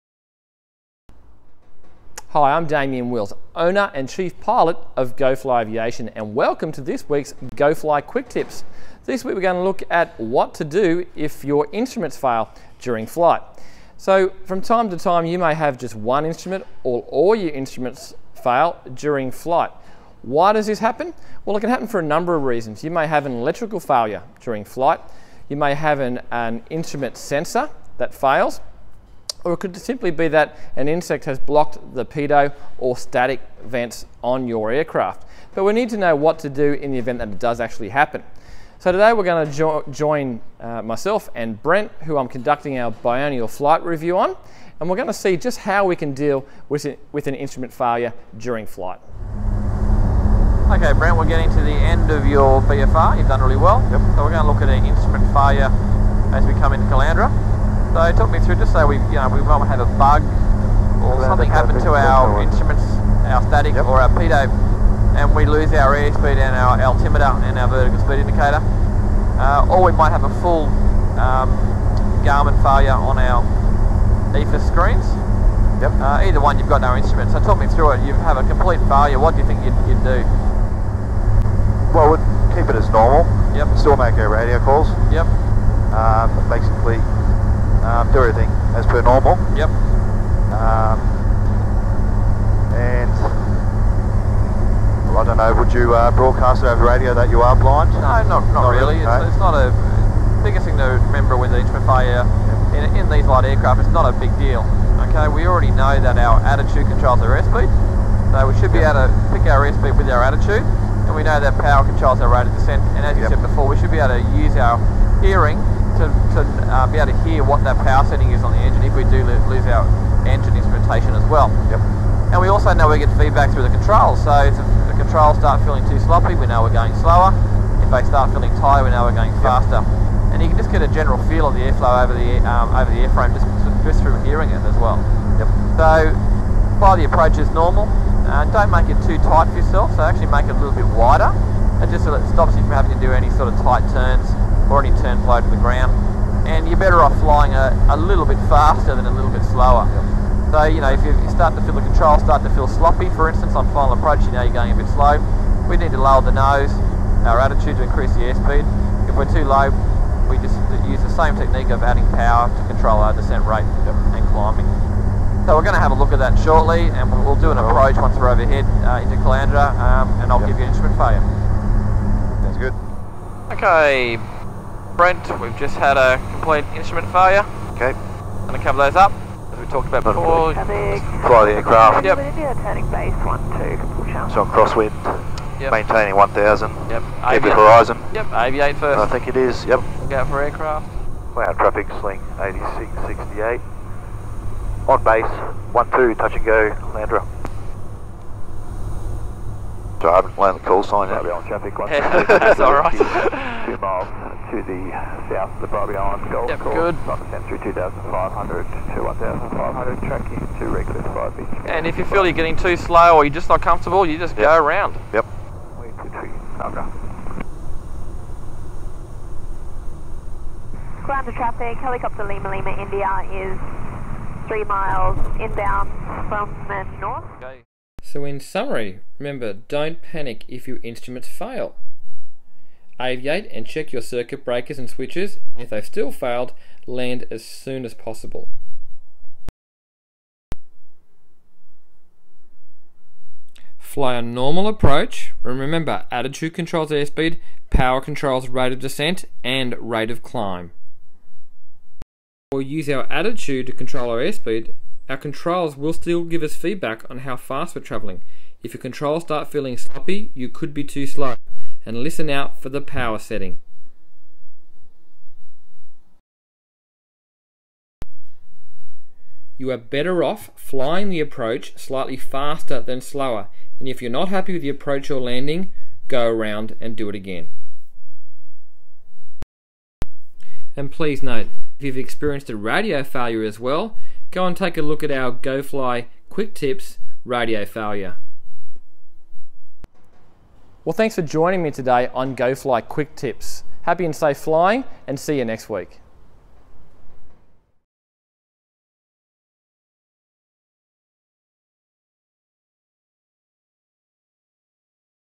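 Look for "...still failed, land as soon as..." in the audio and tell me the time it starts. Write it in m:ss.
3:55.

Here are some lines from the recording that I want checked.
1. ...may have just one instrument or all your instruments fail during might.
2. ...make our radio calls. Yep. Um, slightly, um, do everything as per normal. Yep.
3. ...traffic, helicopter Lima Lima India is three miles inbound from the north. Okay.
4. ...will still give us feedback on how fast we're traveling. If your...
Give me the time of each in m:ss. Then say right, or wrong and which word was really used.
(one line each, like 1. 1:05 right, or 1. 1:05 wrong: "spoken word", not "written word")
1. 0:15 wrong: "flight", not "might"
2. 1:23 wrong: "basically", not "slightly"
3. 3:41 right
4. 4:15 right.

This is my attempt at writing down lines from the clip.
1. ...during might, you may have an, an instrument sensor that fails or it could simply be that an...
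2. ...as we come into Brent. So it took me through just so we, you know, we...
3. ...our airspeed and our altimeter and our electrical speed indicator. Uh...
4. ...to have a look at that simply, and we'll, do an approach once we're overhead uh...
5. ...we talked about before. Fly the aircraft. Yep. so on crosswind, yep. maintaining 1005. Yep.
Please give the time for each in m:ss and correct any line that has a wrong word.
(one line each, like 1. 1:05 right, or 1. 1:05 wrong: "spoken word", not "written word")
1. 0:24 wrong: "flight", not "might"
2. 0:56 wrong: "Caloundra", not "Brent"
3. 1:05 wrong: "vertical", not "electrical"
4. 2:45 wrong: "shortly", not "simply"
5. 2:59 wrong: "1000", not "1005".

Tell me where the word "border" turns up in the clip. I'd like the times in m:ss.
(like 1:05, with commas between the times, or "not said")
not said.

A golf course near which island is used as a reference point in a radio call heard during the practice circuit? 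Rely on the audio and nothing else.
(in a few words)
Bribie Island.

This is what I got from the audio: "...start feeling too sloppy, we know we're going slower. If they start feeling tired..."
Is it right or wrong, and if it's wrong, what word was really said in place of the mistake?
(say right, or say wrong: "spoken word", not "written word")
right.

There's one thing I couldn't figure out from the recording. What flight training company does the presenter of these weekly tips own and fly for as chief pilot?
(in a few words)
GoFly Aviation.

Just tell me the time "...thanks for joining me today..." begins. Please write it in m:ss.
4:50.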